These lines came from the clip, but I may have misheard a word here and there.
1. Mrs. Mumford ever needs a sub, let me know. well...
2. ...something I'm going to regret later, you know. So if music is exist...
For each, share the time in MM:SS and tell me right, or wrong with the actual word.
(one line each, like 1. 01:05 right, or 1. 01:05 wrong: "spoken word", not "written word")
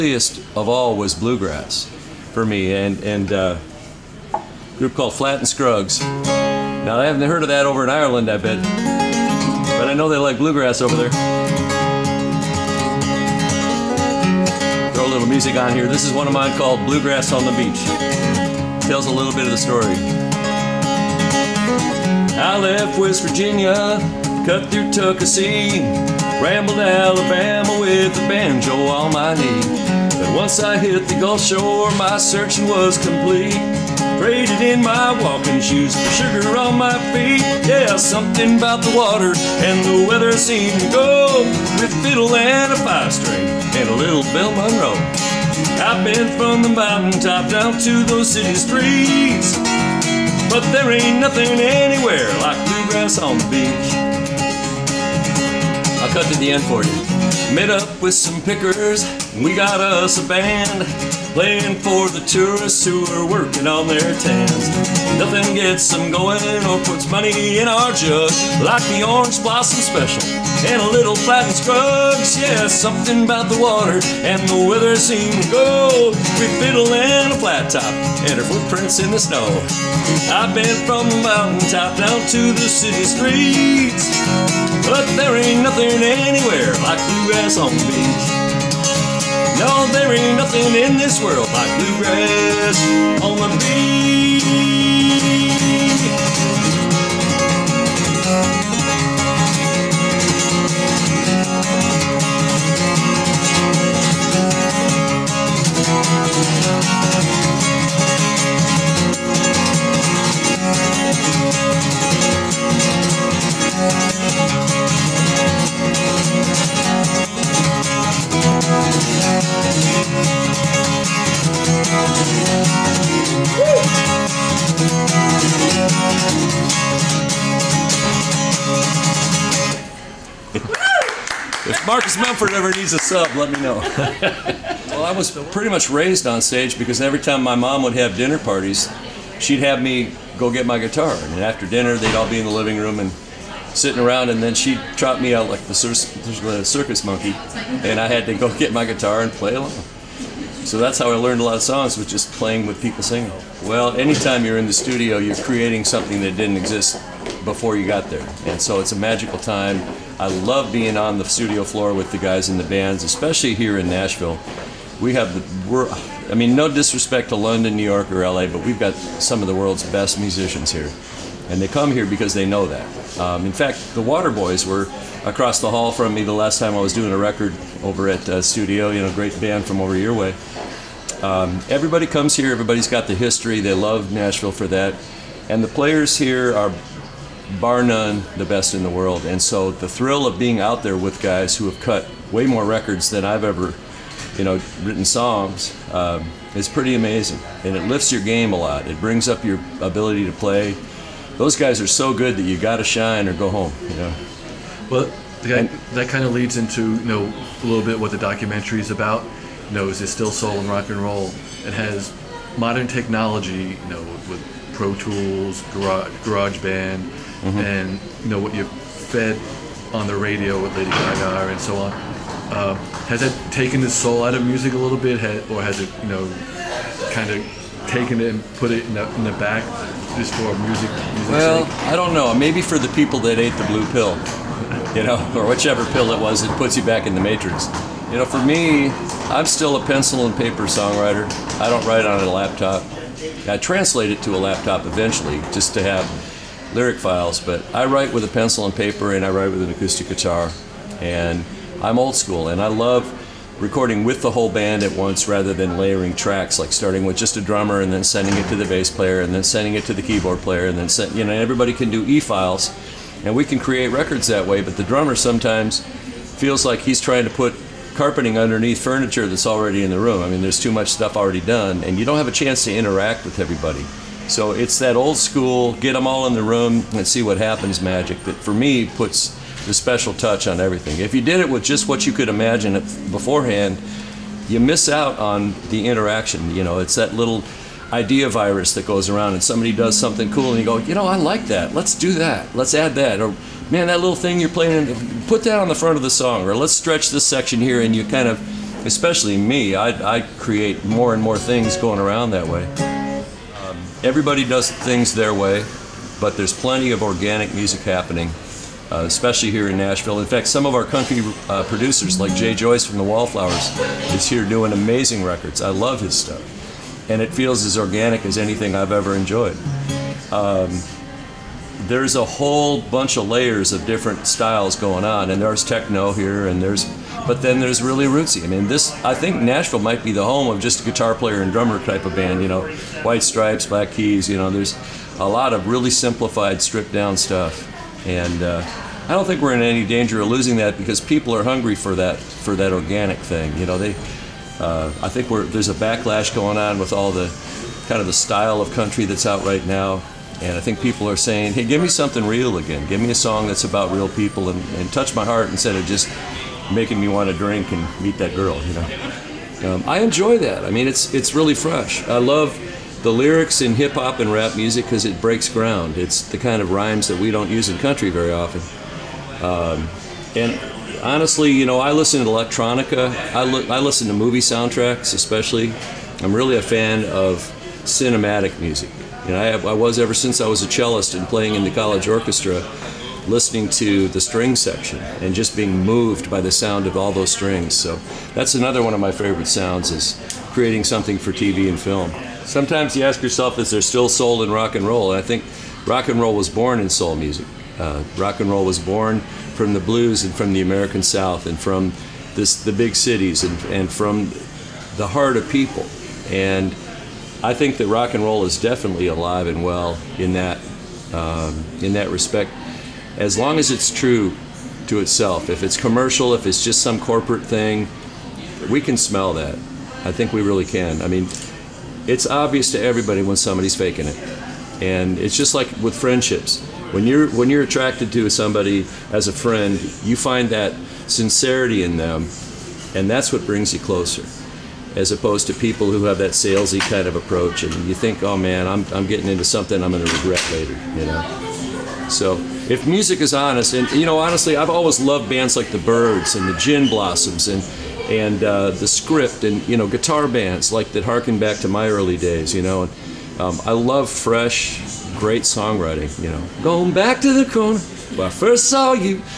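1. 02:12 right
2. 07:19 wrong: "honest", not "exist".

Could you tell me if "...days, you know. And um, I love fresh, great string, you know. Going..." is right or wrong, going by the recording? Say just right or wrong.
wrong.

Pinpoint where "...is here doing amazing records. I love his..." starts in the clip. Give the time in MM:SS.
05:14.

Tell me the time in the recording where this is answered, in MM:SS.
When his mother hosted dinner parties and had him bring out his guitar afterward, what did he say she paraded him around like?
02:26.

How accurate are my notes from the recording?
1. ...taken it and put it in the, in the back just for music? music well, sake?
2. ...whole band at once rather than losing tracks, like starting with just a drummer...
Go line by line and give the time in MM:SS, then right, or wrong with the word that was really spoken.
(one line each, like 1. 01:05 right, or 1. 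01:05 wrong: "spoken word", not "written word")
1. 03:47 right
2. 04:14 wrong: "layering", not "losing".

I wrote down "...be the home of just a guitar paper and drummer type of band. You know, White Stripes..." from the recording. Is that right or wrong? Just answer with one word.
wrong.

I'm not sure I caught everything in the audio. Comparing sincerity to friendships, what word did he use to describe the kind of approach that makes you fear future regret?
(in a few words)
salesy.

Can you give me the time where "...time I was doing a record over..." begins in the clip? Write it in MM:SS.
02:56.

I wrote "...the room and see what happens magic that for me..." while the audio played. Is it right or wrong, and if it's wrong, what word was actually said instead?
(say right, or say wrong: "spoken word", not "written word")
right.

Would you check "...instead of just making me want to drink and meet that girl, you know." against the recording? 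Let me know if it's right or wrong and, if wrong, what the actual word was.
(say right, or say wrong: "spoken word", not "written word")
right.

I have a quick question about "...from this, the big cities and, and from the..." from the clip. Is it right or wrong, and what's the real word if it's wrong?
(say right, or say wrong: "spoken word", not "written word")
right.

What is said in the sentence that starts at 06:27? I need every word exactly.
So that's another one of my favorite sounds is creating something for TV and film.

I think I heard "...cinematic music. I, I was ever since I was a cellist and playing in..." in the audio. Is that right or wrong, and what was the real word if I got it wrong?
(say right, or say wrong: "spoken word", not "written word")
right.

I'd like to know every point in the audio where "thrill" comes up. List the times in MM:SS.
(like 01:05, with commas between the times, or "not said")
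03:09.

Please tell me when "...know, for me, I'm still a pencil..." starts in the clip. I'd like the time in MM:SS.
03:58.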